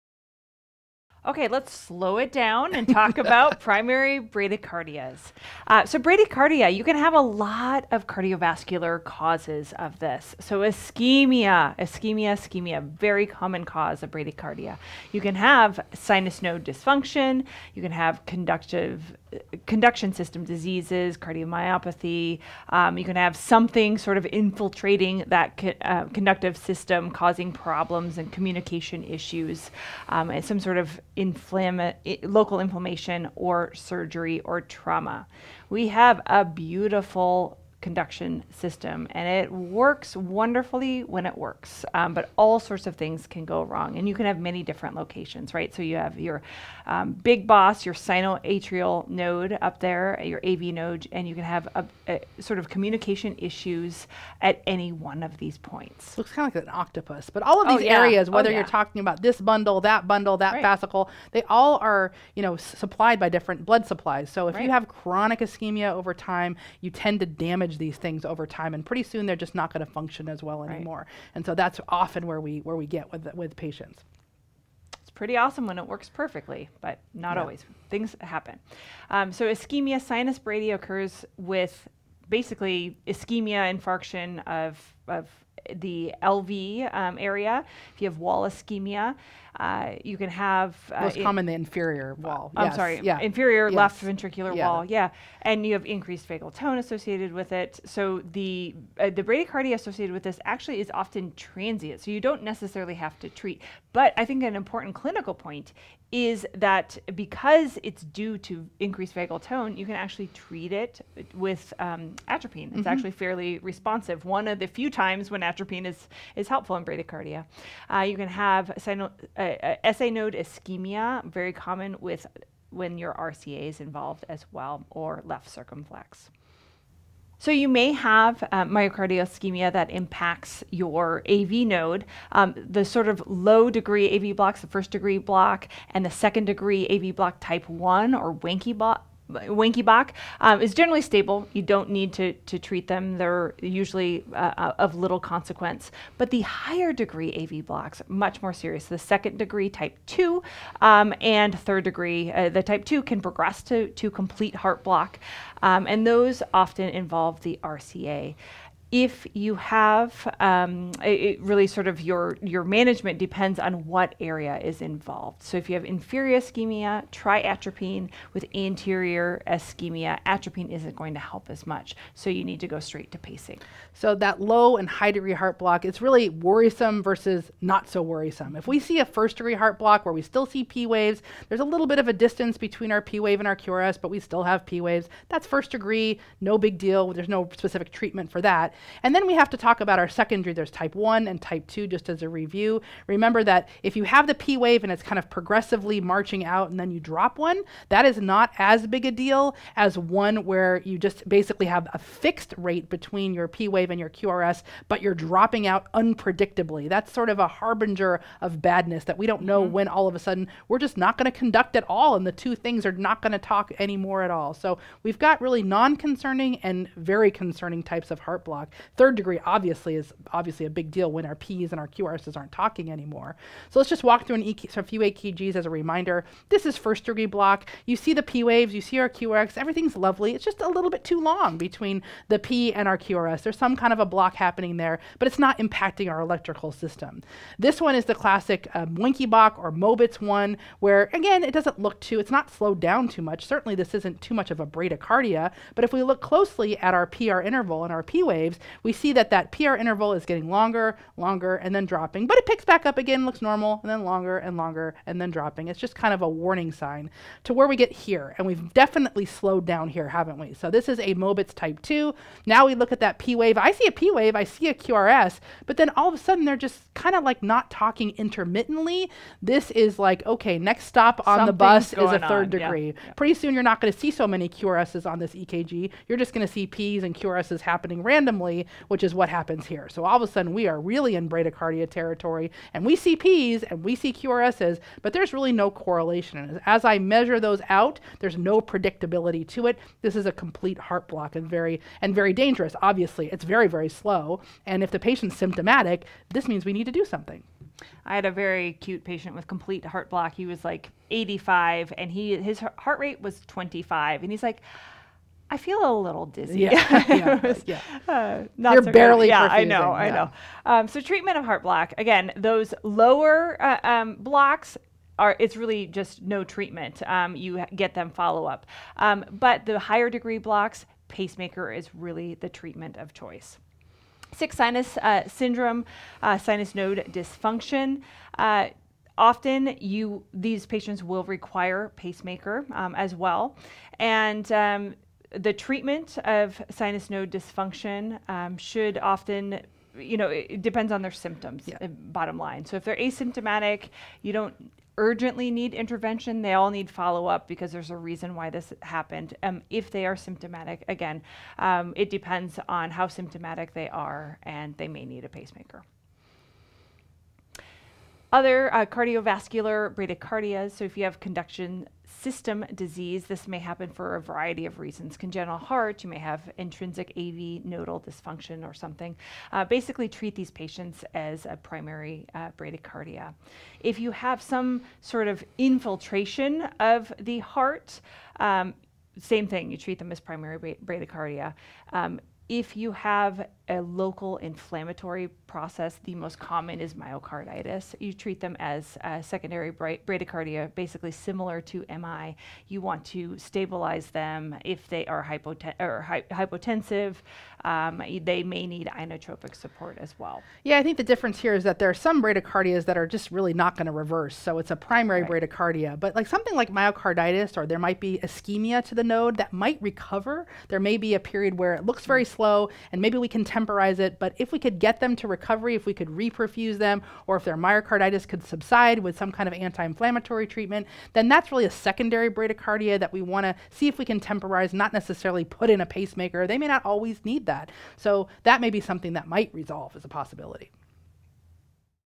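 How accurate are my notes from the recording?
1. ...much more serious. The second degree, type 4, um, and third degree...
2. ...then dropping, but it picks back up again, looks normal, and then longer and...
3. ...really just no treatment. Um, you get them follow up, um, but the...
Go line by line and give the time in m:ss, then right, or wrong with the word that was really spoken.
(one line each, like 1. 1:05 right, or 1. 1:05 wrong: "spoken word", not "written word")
1. 2:28 wrong: "2", not "4"
2. 4:11 right
3. 5:15 right.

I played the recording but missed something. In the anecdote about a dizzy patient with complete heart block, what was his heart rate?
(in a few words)
25.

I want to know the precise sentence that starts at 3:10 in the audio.
There's type 1 and type 2, just as a review.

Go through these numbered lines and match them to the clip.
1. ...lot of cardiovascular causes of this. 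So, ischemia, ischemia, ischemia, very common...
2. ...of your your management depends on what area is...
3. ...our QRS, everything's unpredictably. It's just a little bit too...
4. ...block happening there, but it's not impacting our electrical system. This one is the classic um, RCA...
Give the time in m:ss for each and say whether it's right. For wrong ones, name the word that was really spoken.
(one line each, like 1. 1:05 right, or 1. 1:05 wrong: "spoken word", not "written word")
1. 0:07 right
2. 2:41 right
3. 3:48 wrong: "lovely", not "unpredictably"
4. 3:54 wrong: "Wenckebach", not "RCA".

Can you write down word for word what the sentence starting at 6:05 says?
Congenital heart, you may have intrinsic AV nodal dysfunction or something.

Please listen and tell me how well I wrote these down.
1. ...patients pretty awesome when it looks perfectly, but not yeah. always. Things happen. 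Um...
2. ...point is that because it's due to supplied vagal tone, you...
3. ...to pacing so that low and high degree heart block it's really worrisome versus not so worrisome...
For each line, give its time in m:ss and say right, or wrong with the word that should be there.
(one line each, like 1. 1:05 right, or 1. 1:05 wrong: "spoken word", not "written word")
1. 1:13 wrong: "works", not "looks"
2. 1:45 wrong: "increased", not "supplied"
3. 2:53 right.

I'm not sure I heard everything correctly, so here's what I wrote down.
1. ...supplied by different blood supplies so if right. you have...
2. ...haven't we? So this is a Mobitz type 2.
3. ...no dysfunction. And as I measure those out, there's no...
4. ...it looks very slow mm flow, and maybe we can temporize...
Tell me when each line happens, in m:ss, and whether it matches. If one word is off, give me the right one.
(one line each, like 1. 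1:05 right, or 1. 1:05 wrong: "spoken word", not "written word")
1. 1:02 right
2. 4:20 right
3. 4:45 wrong: "correlation", not "dysfunction"
4. 6:51 right.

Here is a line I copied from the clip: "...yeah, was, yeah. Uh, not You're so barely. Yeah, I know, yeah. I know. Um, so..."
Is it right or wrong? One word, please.
right.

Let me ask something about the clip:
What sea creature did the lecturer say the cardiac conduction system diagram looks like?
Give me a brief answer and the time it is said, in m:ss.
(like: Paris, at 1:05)
Octopus, at 0:56.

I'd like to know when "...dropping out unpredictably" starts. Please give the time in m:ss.
3:25.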